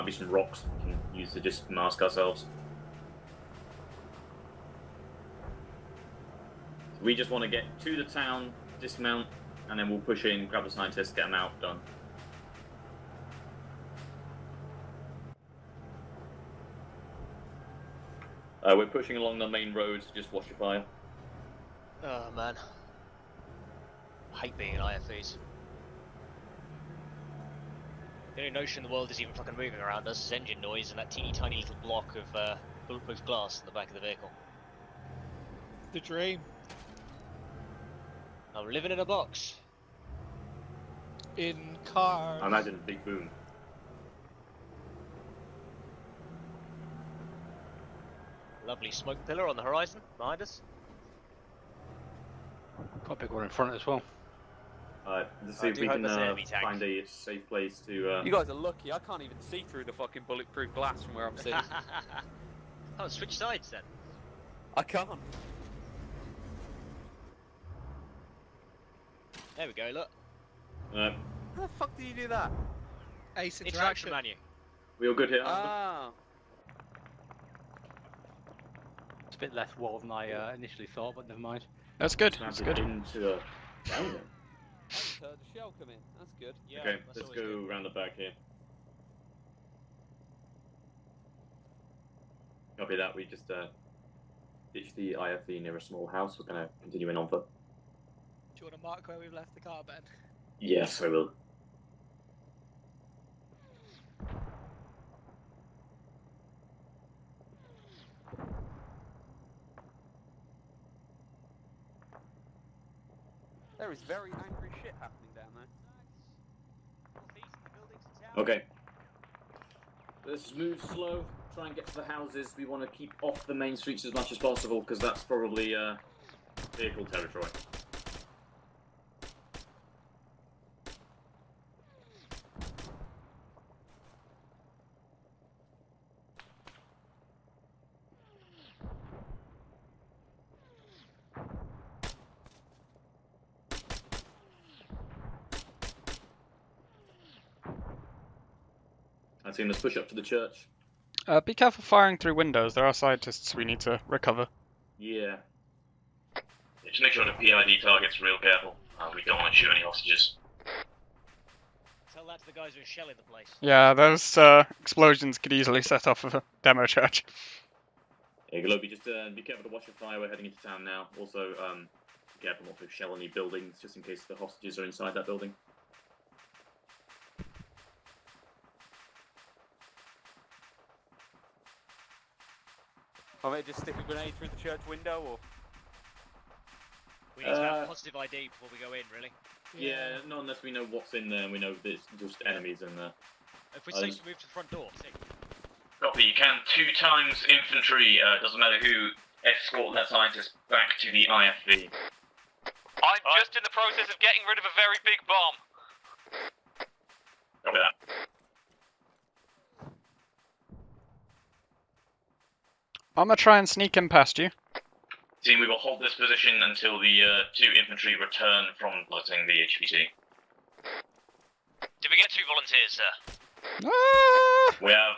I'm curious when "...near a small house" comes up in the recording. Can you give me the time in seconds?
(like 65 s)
95 s.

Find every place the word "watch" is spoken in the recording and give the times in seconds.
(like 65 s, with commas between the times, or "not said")
20 s, 169 s.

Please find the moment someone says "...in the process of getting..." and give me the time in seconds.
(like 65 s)
203 s.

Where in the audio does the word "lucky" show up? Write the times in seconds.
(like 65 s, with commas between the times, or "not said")
58 s.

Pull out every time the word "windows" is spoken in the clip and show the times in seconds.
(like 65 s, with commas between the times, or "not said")
152 s, 184 s.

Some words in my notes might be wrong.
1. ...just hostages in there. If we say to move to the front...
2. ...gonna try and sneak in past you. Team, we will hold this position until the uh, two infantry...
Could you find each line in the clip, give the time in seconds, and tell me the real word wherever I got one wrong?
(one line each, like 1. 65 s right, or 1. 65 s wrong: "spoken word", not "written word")
1. 192 s wrong: "enemies", not "hostages"
2. 213 s right.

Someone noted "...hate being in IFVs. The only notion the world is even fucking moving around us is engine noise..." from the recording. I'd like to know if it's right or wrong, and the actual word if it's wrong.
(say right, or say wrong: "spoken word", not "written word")
right.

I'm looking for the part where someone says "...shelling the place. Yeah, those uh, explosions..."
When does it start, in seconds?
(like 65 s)
162 s.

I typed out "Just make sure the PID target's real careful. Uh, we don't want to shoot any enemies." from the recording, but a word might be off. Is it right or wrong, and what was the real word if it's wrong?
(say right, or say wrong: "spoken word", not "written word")
wrong: "hostages", not "enemies".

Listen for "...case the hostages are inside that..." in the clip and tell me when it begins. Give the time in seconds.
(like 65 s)
174 s.